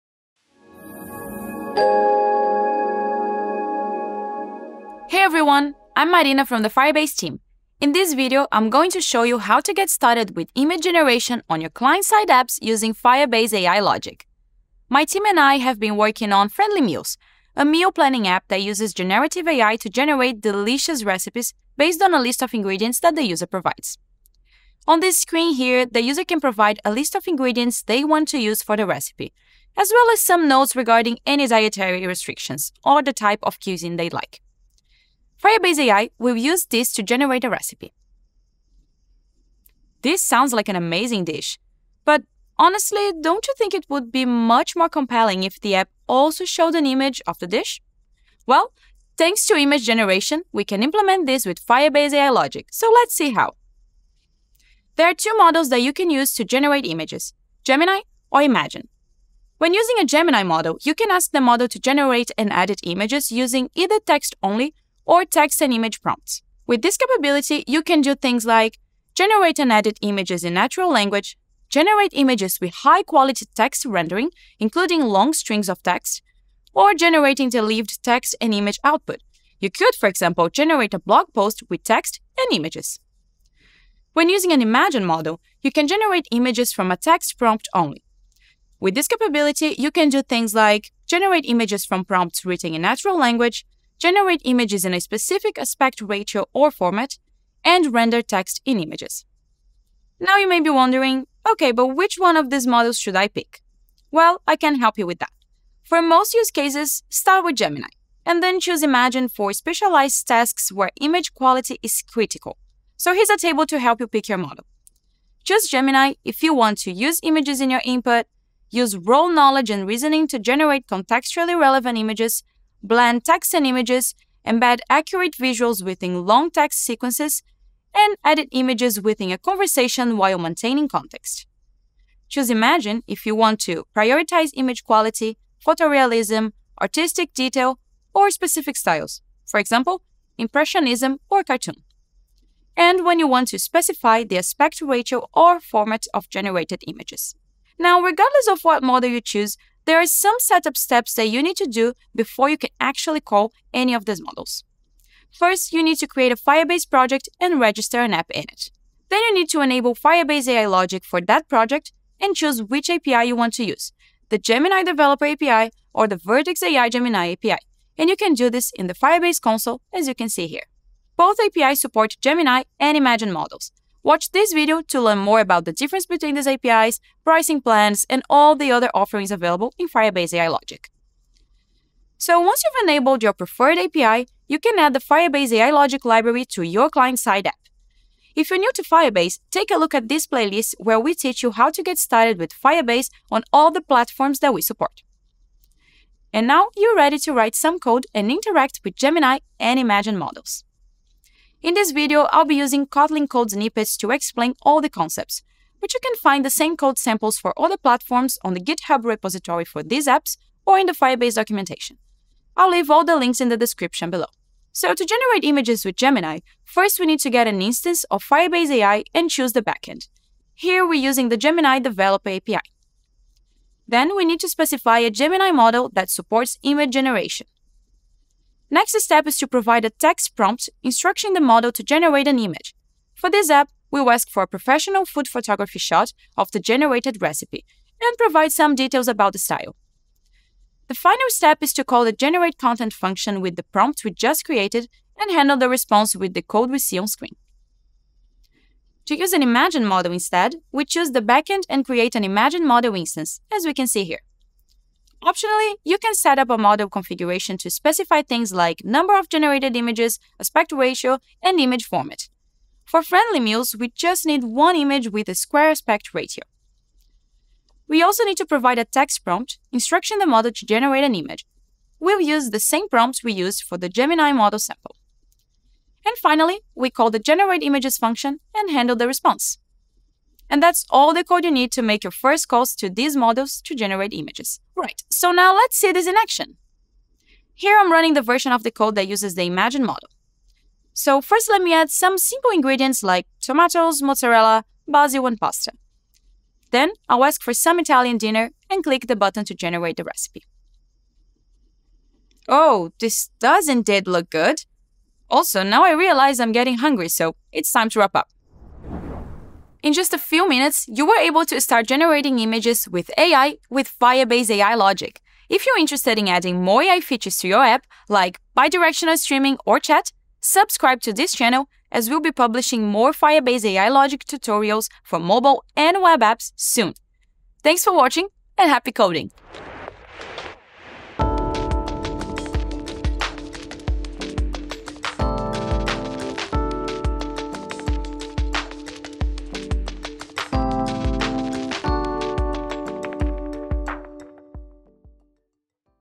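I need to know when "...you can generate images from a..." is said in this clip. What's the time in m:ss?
1:25.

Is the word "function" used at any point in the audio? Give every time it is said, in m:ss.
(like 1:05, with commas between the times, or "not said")
4:02, 4:37.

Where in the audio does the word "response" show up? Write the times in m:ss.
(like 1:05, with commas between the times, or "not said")
4:05, 4:39.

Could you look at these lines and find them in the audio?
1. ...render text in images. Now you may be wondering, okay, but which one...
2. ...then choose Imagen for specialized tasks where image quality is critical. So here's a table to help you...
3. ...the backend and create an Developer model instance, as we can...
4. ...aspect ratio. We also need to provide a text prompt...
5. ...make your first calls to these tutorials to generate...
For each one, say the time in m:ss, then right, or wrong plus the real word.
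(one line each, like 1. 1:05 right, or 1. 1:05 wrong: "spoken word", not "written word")
1. 1:37 right
2. 1:48 right
3. 4:11 wrong: "Imagen", not "Developer"
4. 4:25 right
5. 4:41 wrong: "models", not "tutorials".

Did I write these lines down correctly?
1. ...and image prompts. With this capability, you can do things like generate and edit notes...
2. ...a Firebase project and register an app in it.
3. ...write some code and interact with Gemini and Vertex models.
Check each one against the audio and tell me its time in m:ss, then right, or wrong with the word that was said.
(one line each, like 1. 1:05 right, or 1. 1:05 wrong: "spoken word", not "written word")
1. 1:05 wrong: "images", not "notes"
2. 2:36 right
3. 3:17 wrong: "Imagen", not "Vertex".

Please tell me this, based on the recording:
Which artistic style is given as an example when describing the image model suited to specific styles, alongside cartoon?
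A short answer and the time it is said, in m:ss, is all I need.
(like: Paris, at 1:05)
Impressionism, at 2:20.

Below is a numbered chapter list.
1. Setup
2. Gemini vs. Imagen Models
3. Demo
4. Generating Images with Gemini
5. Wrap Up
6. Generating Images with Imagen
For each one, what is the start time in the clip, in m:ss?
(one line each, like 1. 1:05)
1. 2:27
2. 0:53
3. 4:45
4. 3:34
5. 5:08
6. 4:08.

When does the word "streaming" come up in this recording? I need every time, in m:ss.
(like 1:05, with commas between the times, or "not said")
5:19.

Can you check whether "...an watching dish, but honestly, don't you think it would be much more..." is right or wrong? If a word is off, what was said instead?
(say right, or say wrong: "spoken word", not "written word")
wrong: "amazing", not "watching".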